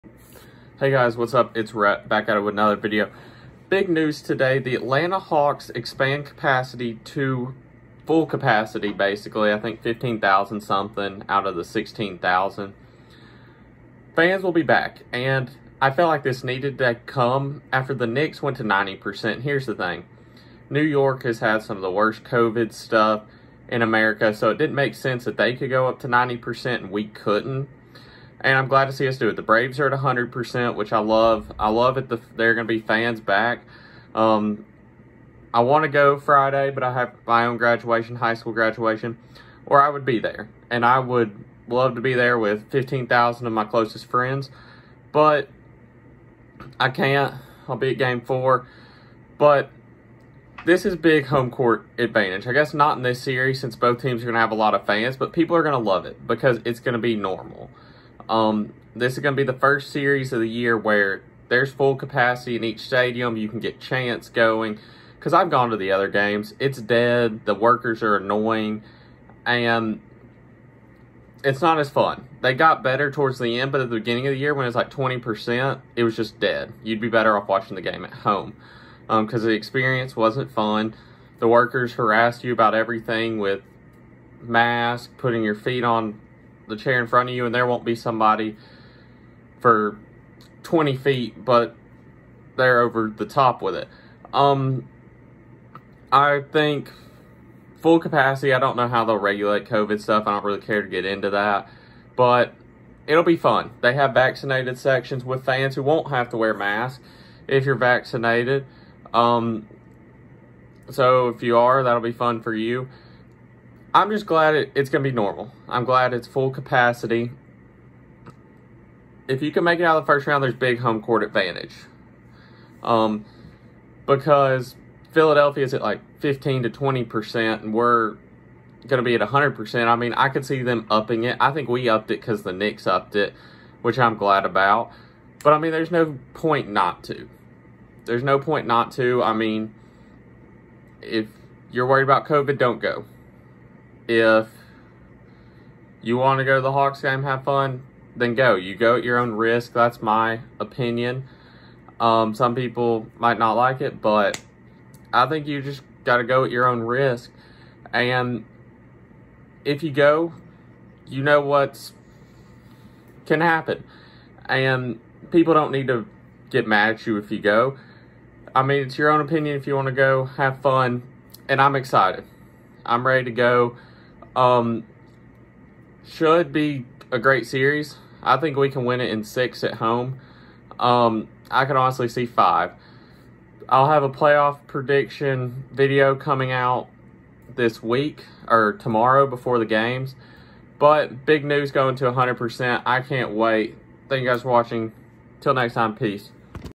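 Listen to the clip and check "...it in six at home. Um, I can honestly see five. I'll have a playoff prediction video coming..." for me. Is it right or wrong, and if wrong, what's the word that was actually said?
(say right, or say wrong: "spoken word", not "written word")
right.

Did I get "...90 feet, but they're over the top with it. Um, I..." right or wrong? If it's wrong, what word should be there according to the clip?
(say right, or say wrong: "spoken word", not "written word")
wrong: "20", not "90".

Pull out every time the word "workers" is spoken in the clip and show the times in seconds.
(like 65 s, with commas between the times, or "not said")
67 s, 81 s.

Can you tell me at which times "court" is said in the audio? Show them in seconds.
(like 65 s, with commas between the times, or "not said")
51 s, 121 s.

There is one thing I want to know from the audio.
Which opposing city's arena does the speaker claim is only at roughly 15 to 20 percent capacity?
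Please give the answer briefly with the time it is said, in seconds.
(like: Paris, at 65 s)
Philadelphia, at 125 s.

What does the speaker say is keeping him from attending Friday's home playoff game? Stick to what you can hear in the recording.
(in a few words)
high school graduation.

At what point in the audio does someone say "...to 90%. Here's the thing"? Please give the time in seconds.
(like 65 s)
18 s.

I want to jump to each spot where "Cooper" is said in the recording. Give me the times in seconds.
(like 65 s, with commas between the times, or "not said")
not said.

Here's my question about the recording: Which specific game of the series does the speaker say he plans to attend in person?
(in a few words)
game 4.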